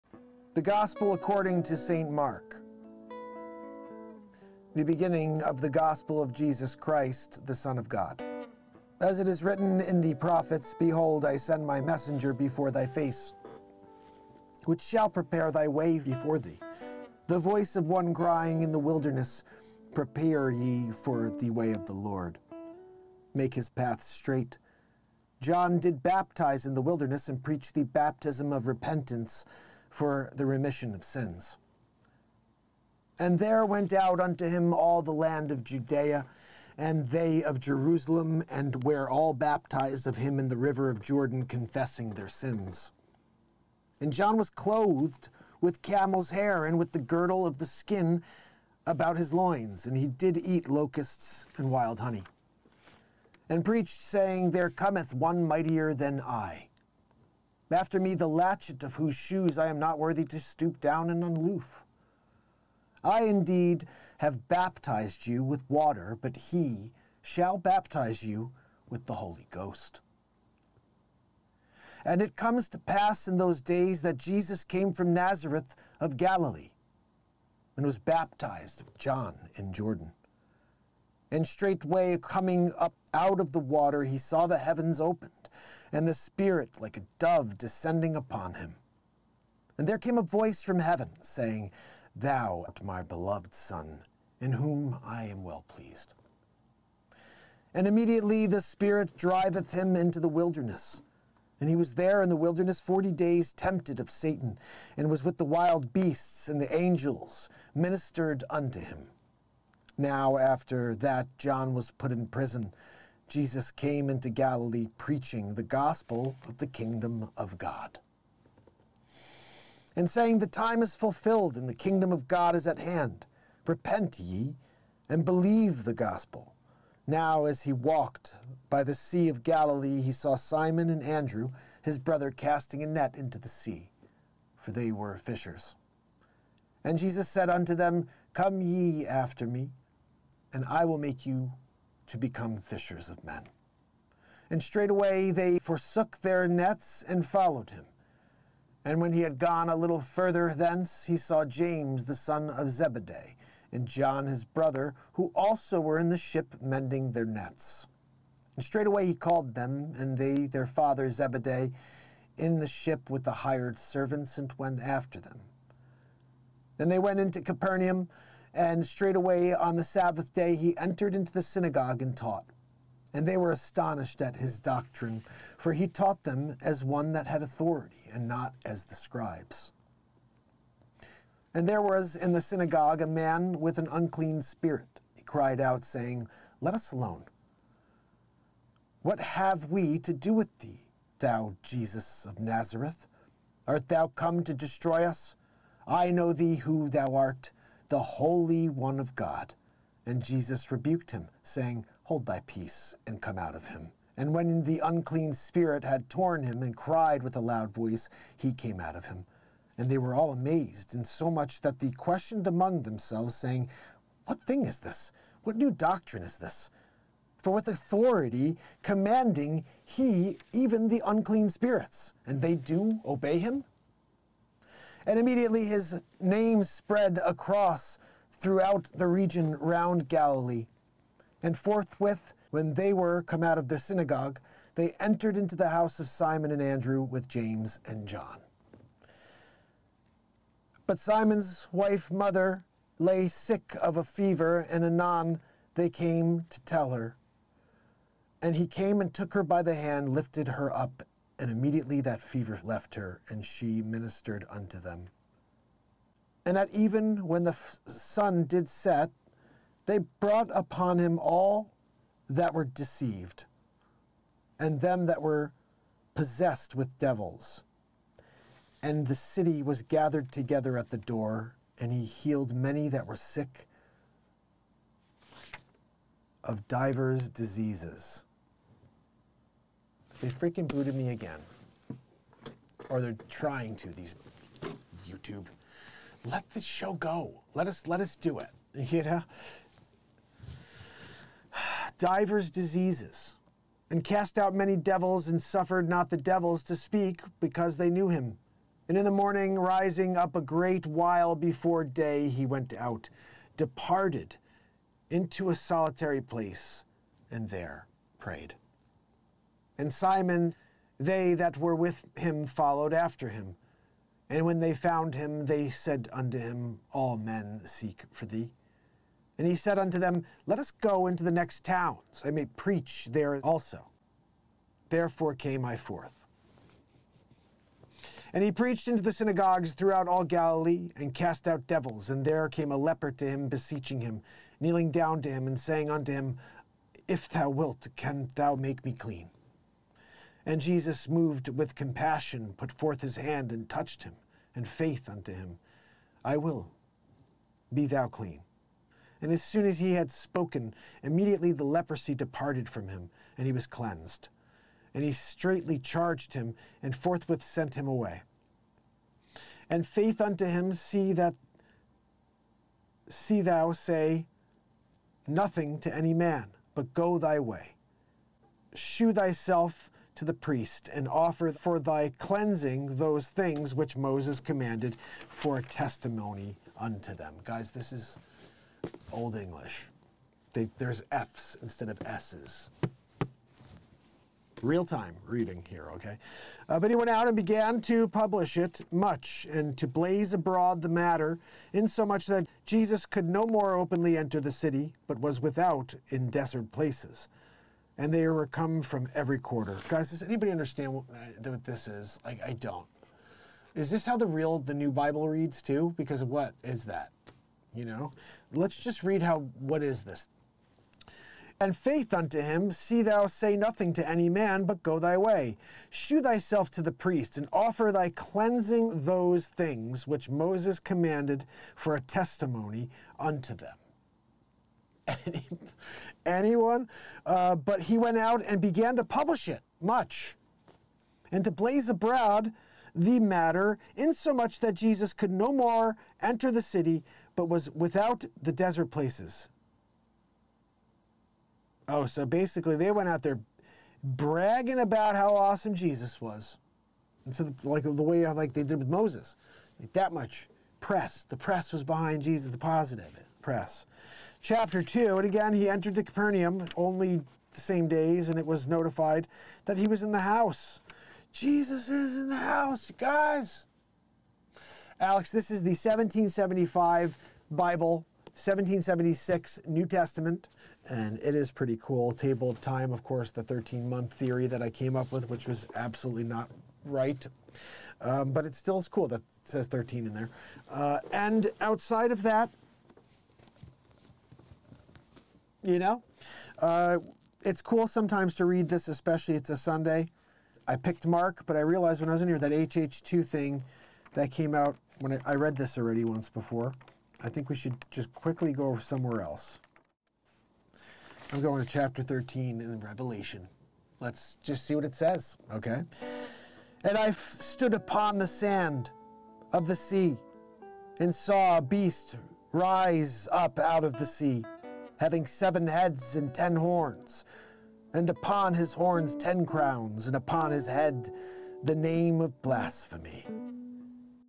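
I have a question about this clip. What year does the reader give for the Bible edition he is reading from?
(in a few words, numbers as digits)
1775.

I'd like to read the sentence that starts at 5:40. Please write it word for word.
And Jesus, moved with compassion, put forth his hand and touched him, and faith unto him.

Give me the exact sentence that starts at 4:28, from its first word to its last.
And the city was gathered together at the door, and he healed many that were sick of divers diseases.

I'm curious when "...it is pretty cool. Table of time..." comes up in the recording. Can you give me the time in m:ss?
7:51.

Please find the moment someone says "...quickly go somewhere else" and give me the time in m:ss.
8:18.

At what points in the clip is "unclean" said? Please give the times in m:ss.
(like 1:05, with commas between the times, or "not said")
3:03, 3:24, 3:41.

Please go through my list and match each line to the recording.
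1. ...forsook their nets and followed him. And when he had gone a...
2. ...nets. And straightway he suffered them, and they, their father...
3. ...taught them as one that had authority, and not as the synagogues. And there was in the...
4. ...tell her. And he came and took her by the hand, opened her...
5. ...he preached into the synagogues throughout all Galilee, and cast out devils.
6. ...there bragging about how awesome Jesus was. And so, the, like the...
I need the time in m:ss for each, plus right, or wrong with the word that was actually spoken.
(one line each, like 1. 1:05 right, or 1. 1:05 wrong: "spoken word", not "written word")
1. 2:25 right
2. 2:37 wrong: "called", not "suffered"
3. 2:55 wrong: "scribes", not "synagogues"
4. 4:06 wrong: "lifted", not "opened"
5. 5:28 right
6. 7:23 right.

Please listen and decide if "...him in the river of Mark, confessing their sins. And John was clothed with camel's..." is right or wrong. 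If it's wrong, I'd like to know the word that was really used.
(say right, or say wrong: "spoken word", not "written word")
wrong: "Jordan", not "Mark".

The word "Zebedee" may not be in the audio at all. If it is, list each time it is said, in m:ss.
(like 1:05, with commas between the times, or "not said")
2:32, 2:41.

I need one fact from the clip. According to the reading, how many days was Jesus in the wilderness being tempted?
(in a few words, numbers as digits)
40.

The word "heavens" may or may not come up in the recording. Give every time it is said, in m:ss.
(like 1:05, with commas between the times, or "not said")
1:24, 1:30.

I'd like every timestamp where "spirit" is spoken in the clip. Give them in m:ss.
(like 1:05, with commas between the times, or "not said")
1:26, 1:38, 3:04, 3:25, 3:41.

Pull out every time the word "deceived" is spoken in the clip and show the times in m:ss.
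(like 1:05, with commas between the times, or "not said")
4:22.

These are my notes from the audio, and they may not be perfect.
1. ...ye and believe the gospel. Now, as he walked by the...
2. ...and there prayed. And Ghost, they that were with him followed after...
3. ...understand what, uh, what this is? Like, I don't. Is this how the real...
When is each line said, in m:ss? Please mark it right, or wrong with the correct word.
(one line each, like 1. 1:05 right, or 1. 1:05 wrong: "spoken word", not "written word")
1. 2:04 right
2. 5:07 wrong: "Simon", not "Ghost"
3. 6:40 right.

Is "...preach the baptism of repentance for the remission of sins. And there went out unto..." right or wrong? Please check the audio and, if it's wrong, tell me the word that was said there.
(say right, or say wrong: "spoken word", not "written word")
right.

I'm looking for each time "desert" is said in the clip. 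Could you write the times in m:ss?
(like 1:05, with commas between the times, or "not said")
6:36, 7:18.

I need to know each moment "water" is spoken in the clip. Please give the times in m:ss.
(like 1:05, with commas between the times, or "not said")
1:05, 1:23.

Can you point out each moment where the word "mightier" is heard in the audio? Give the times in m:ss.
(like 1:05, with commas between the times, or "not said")
0:55.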